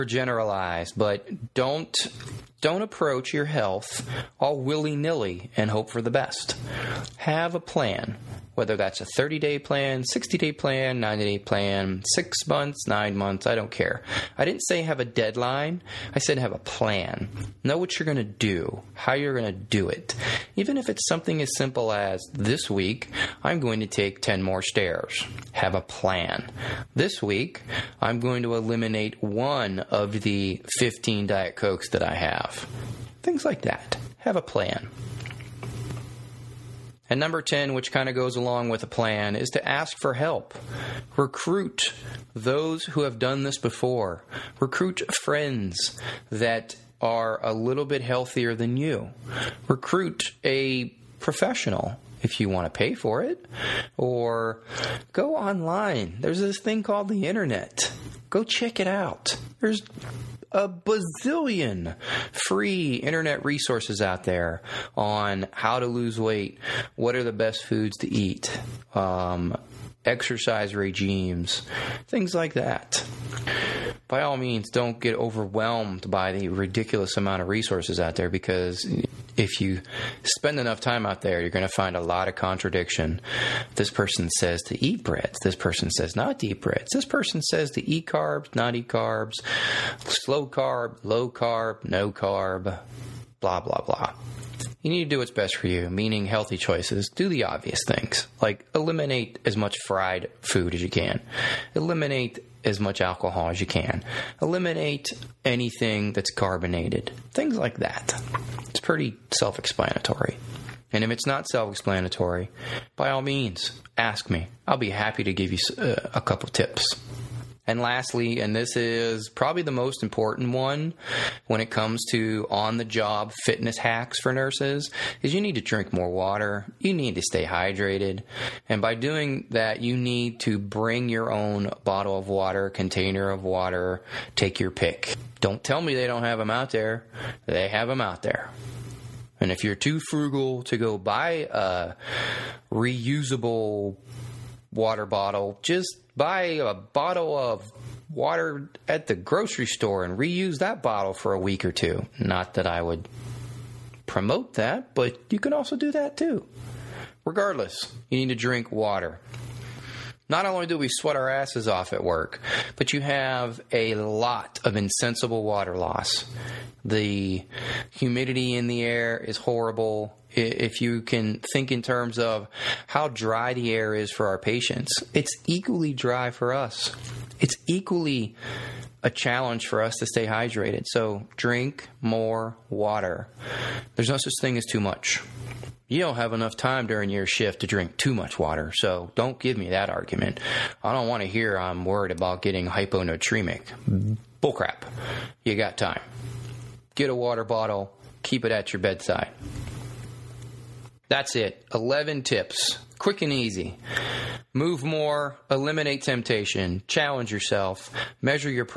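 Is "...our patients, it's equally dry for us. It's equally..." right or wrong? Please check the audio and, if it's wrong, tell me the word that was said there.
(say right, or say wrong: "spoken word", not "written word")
right.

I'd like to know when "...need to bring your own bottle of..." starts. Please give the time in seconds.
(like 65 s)
129 s.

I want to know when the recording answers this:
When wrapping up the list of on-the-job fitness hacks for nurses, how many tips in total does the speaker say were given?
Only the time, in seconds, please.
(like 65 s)
201 s.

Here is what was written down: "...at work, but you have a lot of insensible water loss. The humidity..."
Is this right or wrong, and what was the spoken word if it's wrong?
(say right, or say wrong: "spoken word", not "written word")
right.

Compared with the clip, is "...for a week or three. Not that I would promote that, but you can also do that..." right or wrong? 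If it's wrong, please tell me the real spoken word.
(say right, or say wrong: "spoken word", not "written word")
wrong: "two", not "three".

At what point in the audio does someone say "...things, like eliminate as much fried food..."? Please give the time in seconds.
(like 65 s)
97 s.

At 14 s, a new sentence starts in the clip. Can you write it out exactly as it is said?
I didn't say have a deadline.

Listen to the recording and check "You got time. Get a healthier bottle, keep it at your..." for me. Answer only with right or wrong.
wrong.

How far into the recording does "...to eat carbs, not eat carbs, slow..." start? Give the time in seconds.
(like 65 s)
87 s.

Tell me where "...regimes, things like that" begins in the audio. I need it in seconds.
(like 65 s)
70 s.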